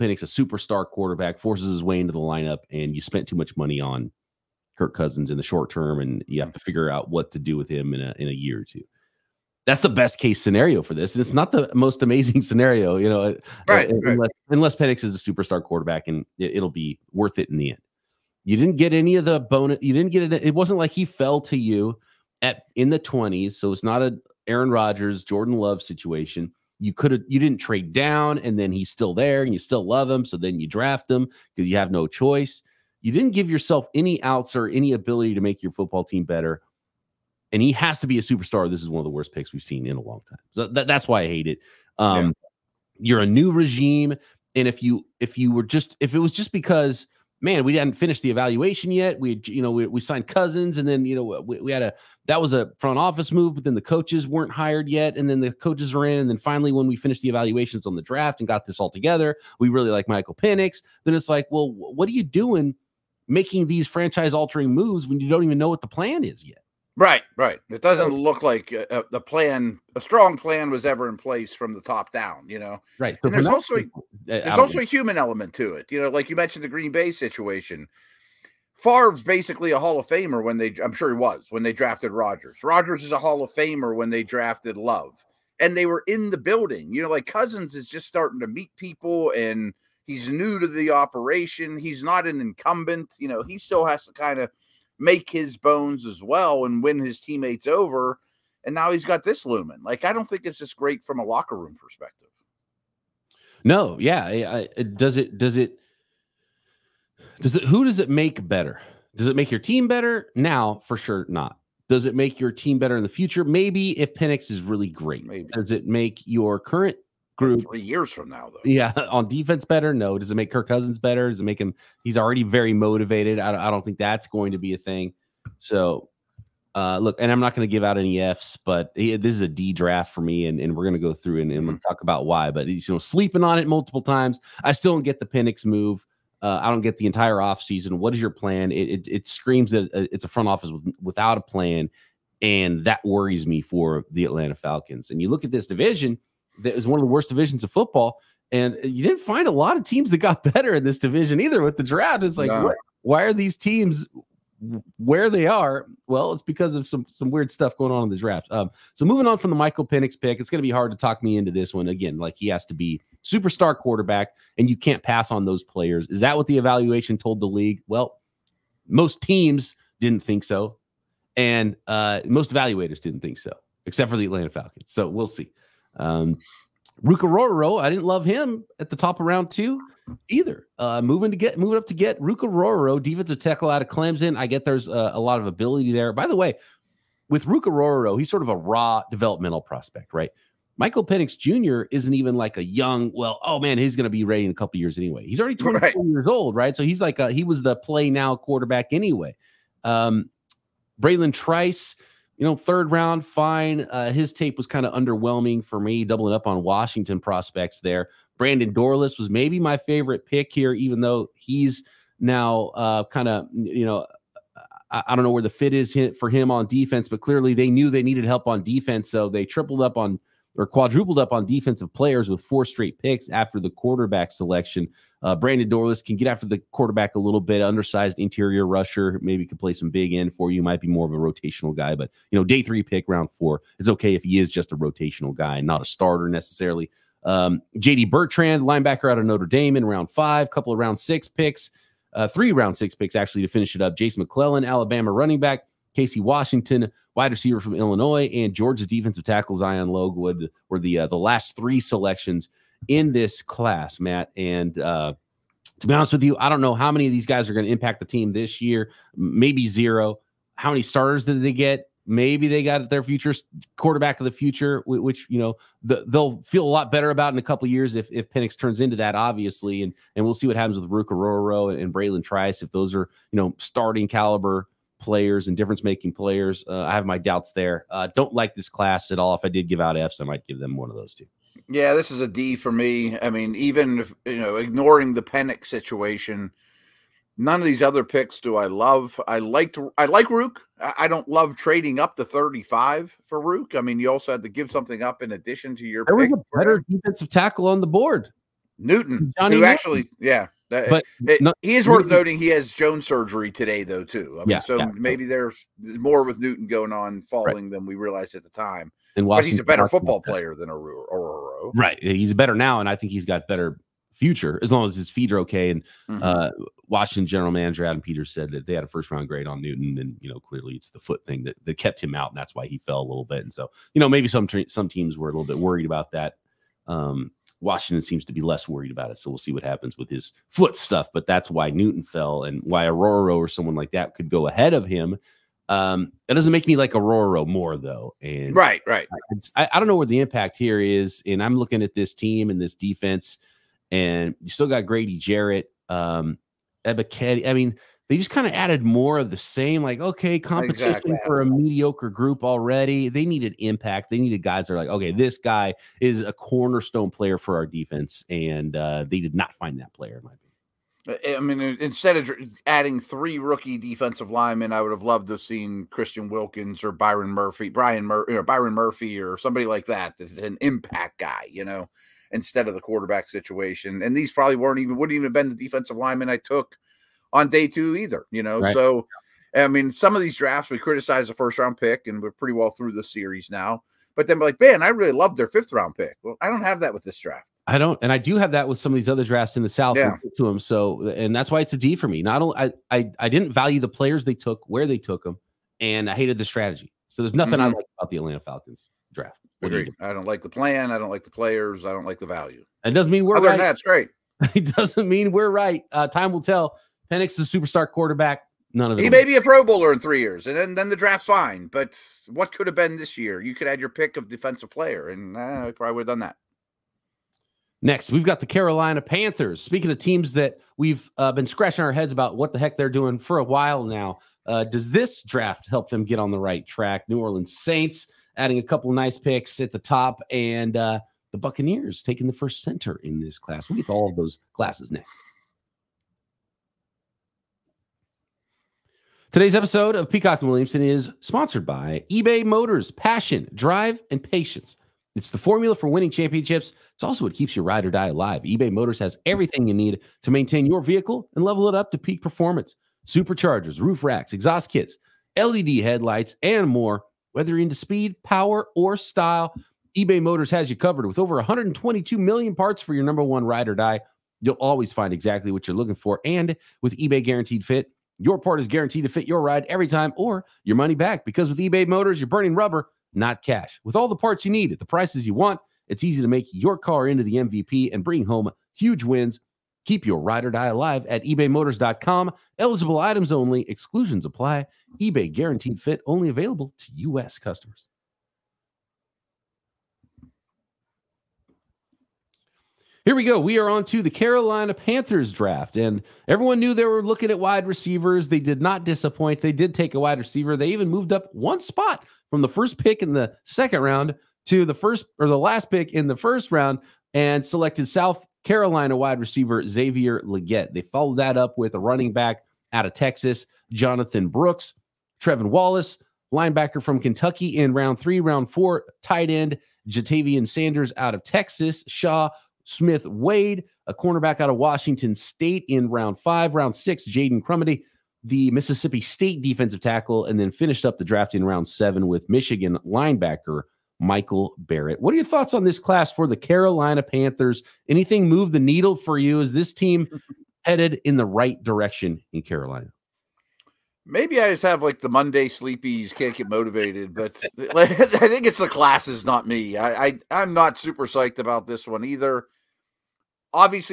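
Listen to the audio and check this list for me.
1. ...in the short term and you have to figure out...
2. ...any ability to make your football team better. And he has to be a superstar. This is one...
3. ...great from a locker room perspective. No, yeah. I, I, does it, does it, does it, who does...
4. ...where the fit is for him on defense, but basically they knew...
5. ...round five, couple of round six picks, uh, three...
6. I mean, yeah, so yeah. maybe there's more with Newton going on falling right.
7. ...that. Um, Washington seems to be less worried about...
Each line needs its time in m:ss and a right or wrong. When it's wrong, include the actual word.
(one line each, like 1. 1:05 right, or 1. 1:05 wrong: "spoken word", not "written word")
1. 0:05 right
2. 0:34 right
3. 1:40 right
4. 3:35 wrong: "clearly", not "basically"
5. 3:59 right
6. 5:04 right
7. 5:26 right.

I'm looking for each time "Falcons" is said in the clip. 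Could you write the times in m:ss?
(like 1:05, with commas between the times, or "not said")
2:24, 2:54, 6:38.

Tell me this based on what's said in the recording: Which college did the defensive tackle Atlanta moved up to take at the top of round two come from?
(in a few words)
Clemson.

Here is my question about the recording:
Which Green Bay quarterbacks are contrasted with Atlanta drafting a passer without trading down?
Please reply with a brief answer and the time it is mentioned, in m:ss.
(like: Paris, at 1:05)
Aaron Rodgers, Jordan Love, at 0:24.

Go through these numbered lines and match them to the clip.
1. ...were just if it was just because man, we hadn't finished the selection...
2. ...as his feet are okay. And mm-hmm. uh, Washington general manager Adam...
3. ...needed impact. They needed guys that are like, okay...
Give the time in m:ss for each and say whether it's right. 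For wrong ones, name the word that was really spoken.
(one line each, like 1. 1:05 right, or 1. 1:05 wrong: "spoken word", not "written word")
1. 0:45 wrong: "evaluation", not "selection"
2. 5:14 right
3. 5:53 right.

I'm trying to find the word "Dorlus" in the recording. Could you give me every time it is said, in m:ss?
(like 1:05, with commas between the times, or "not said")
3:28, 3:45.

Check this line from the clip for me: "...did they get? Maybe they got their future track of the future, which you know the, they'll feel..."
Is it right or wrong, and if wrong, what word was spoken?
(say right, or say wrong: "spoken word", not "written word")
wrong: "quarterback", not "track".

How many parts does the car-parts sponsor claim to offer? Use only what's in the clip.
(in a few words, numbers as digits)
122 million.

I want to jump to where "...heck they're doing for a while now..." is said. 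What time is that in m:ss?
7:02.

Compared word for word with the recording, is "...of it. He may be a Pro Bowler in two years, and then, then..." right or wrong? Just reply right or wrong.
wrong.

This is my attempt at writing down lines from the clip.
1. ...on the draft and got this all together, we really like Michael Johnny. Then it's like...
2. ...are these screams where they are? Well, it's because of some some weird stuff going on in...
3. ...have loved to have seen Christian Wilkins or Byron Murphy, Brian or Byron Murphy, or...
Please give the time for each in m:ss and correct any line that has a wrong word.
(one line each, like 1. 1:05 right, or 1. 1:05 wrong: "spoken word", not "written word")
1. 0:57 wrong: "Penix", not "Johnny"
2. 2:33 wrong: "teams", not "screams"
3. 6:04 right.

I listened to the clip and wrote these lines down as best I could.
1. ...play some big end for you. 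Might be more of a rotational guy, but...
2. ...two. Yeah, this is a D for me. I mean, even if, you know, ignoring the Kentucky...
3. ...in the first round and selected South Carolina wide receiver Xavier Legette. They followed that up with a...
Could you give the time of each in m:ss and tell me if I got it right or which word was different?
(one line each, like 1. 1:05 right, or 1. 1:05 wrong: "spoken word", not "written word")
1. 3:49 right
2. 4:41 wrong: "Penix", not "Kentucky"
3. 8:25 right.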